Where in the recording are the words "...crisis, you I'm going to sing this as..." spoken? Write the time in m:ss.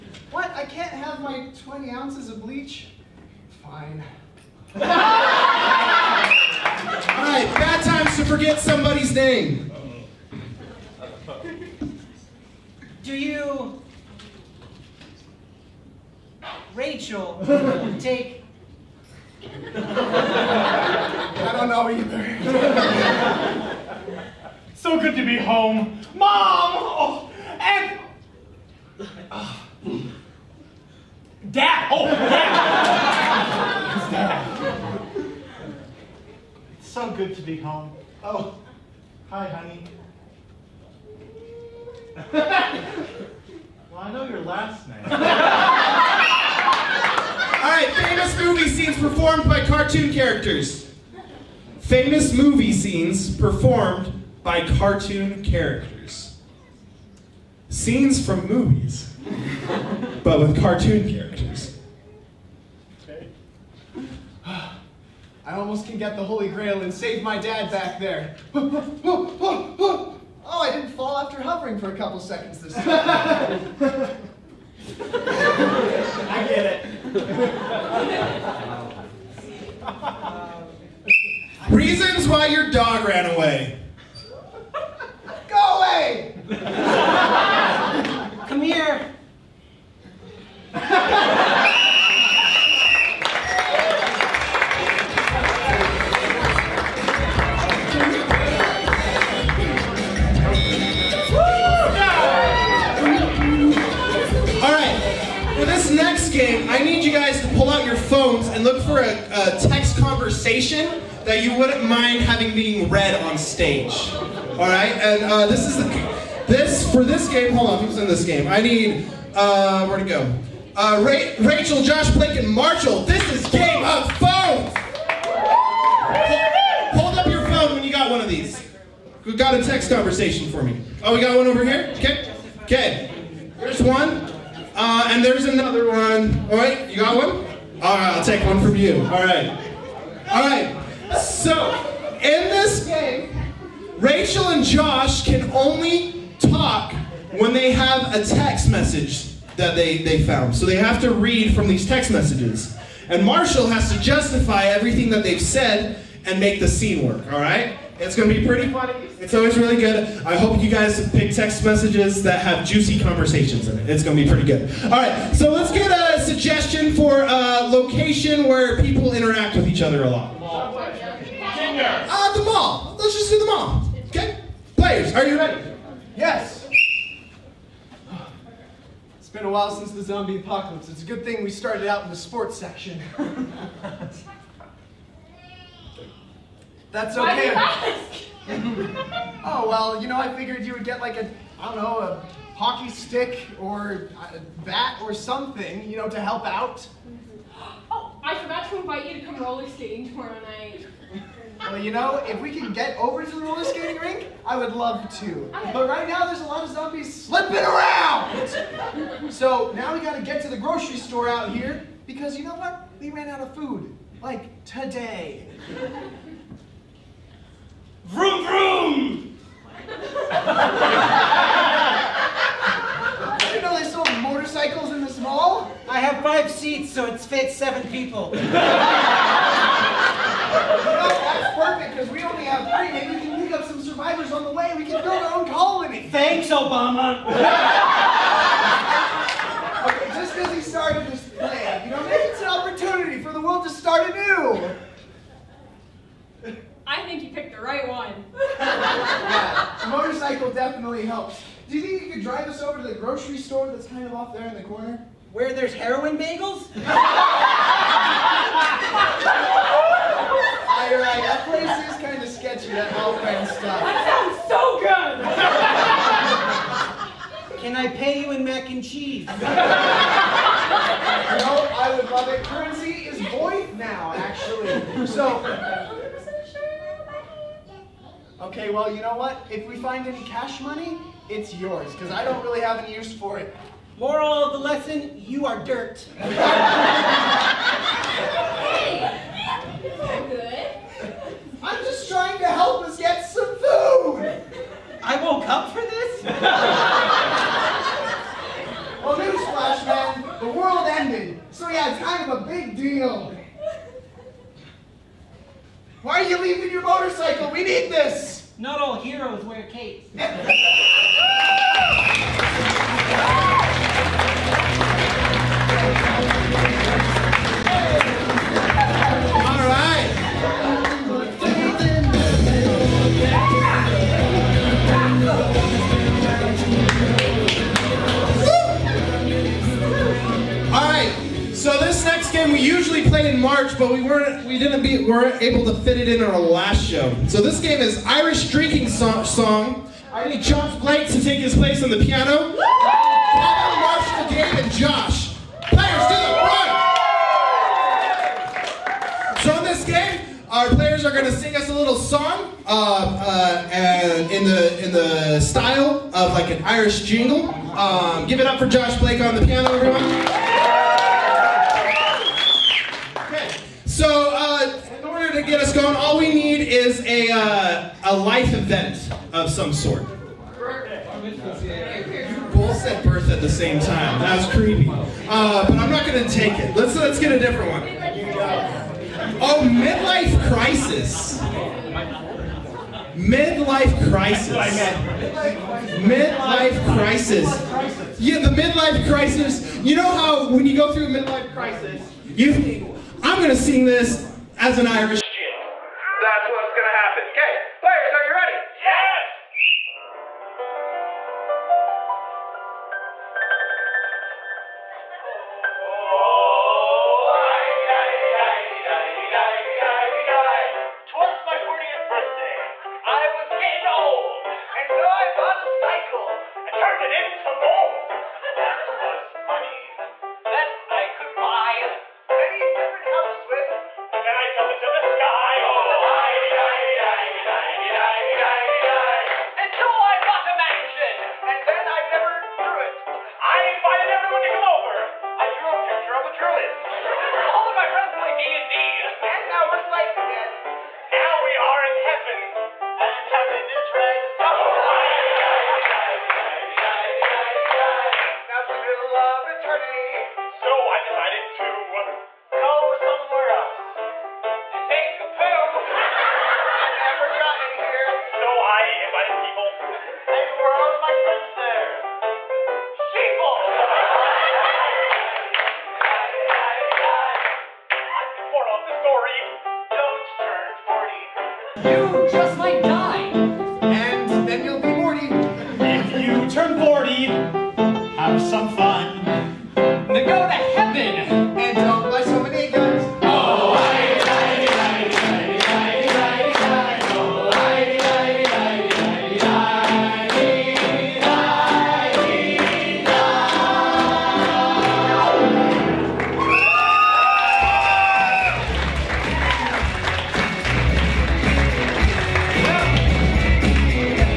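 6:31.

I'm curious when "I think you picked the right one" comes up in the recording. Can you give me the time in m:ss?
4:06.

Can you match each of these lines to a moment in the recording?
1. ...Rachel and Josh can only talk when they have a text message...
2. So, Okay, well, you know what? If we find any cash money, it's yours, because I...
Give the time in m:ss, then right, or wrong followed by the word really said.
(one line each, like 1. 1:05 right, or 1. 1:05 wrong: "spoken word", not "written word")
1. 2:23 right
2. 4:35 right.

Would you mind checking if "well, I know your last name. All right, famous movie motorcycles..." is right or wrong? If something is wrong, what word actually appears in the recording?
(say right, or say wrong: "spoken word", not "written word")
wrong: "scenes", not "motorcycles".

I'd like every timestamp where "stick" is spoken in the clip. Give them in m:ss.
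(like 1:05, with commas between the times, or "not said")
3:12.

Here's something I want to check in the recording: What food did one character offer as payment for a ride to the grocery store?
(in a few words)
Mac and cheese.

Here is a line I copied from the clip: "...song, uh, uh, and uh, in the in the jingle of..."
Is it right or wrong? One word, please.
wrong.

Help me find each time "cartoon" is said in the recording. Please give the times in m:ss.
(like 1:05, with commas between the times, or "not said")
0:49, 0:54, 1:00.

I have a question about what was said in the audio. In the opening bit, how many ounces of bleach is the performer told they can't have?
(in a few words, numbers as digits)
20.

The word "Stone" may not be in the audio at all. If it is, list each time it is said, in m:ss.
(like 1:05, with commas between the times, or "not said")
6:05.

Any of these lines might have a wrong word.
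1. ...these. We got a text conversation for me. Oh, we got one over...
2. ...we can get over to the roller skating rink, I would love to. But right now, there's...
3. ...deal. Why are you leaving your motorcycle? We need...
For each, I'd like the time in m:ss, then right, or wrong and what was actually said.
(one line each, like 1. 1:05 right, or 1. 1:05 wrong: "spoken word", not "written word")
1. 2:08 right
2. 3:22 right
3. 5:02 right.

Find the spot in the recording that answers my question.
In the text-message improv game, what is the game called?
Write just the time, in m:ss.
2:03.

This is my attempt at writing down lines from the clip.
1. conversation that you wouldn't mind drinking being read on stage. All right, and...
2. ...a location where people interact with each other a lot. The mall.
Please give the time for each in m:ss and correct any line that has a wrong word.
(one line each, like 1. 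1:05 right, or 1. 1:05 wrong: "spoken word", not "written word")
1. 1:50 wrong: "having", not "drinking"
2. 2:47 right.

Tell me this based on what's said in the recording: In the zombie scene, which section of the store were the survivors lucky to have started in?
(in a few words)
Sports section.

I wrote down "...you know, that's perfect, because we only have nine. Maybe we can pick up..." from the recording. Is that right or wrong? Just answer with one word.
wrong.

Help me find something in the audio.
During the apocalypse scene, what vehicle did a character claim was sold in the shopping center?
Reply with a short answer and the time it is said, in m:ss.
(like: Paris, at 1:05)
Motorcycles, at 3:44.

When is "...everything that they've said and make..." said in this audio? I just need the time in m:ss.
2:34.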